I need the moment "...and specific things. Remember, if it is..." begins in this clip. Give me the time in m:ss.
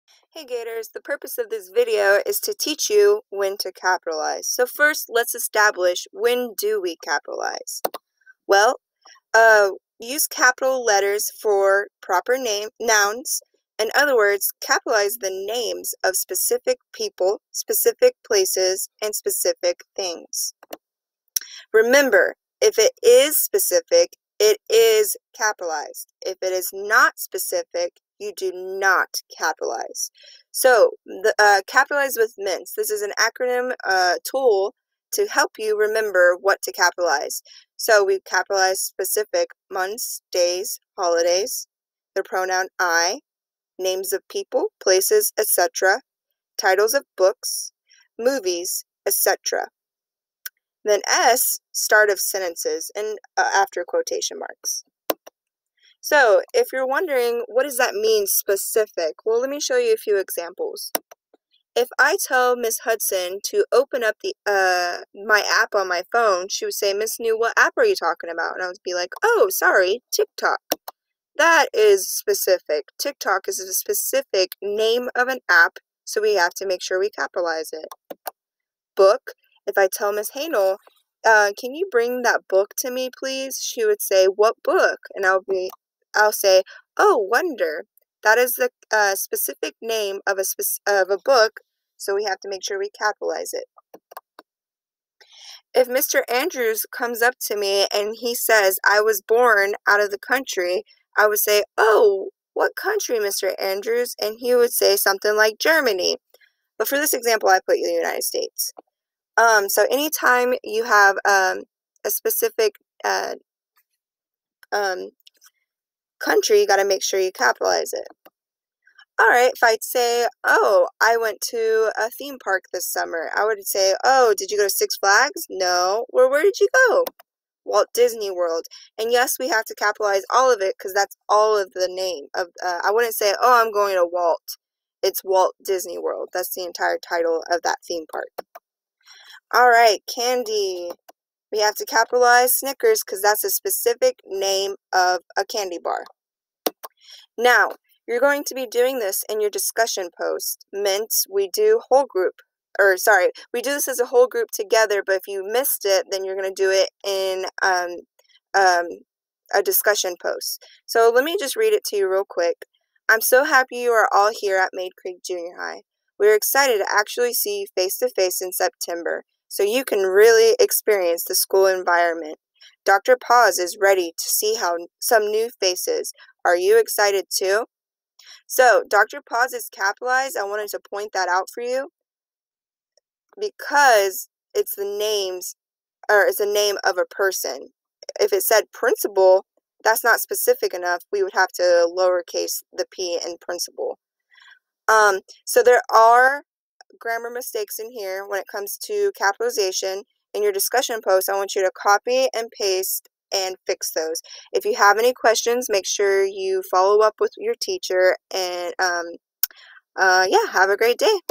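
0:19.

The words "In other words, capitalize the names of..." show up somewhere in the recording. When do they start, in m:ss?
0:13.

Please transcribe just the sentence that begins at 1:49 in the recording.
Um, so anytime you have um, a specific uh, um, country, you got to make sure you capitalize it.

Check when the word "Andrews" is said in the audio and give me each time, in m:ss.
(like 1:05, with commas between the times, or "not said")
1:36, 1:43.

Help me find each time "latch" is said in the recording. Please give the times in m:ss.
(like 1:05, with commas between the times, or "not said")
not said.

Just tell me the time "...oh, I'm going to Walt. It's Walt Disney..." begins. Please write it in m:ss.
2:13.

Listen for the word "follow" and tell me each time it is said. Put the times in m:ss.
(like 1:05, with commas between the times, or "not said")
3:26.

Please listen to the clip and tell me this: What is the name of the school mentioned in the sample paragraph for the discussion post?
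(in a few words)
Maid Creek Junior High.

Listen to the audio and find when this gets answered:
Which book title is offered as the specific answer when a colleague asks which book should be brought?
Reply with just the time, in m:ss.
1:27.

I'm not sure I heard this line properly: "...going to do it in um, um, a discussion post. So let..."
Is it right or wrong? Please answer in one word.
right.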